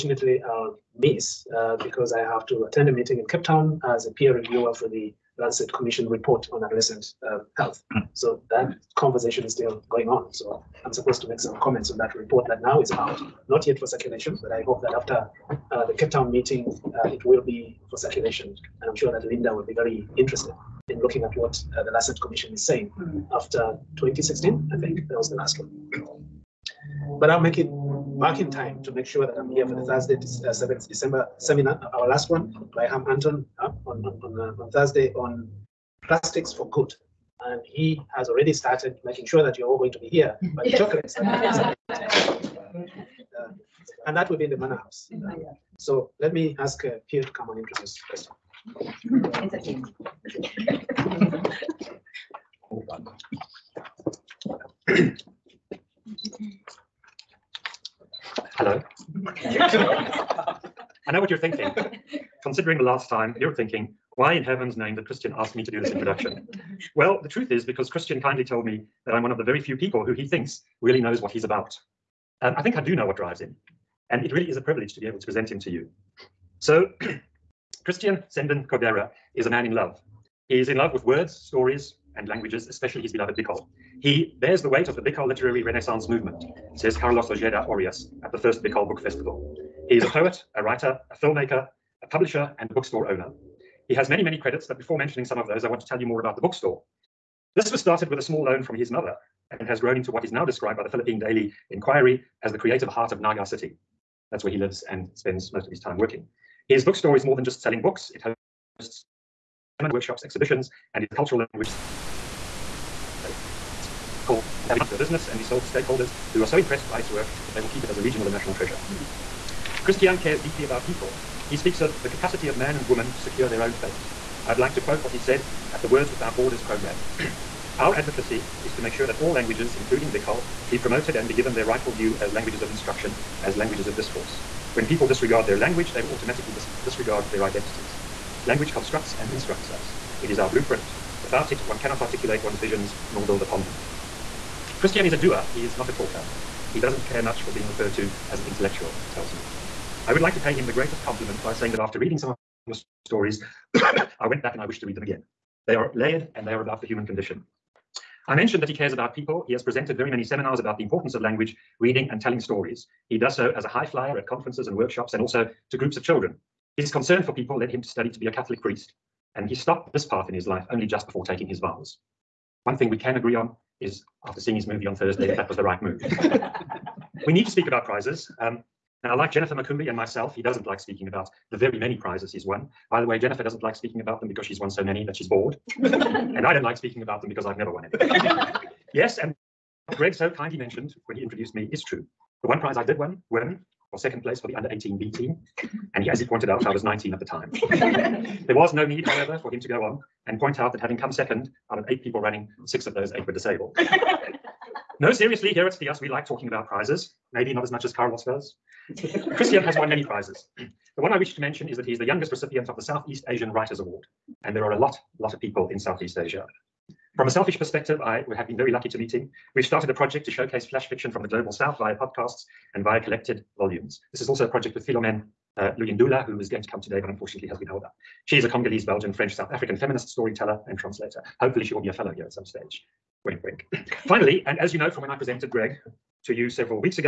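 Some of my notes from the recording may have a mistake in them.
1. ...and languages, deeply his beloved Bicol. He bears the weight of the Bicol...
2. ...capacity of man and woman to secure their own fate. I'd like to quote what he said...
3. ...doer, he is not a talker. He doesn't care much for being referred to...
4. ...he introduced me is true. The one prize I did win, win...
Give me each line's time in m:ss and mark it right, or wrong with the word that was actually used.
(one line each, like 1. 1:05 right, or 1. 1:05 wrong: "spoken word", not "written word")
1. 1:22 wrong: "especially", not "deeply"
2. 2:02 right
3. 2:25 right
4. 3:11 right.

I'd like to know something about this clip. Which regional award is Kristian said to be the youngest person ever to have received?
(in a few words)
Southeast Asian Writers Award.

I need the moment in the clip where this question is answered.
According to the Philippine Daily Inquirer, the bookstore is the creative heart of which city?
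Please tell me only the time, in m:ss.
1:43.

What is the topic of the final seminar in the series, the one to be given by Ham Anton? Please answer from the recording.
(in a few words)
Plastics for good.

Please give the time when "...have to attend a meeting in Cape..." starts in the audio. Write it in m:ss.
0:02.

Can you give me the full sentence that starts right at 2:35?
They are layered and they are about the human condition.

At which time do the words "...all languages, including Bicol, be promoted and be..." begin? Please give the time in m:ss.
2:09.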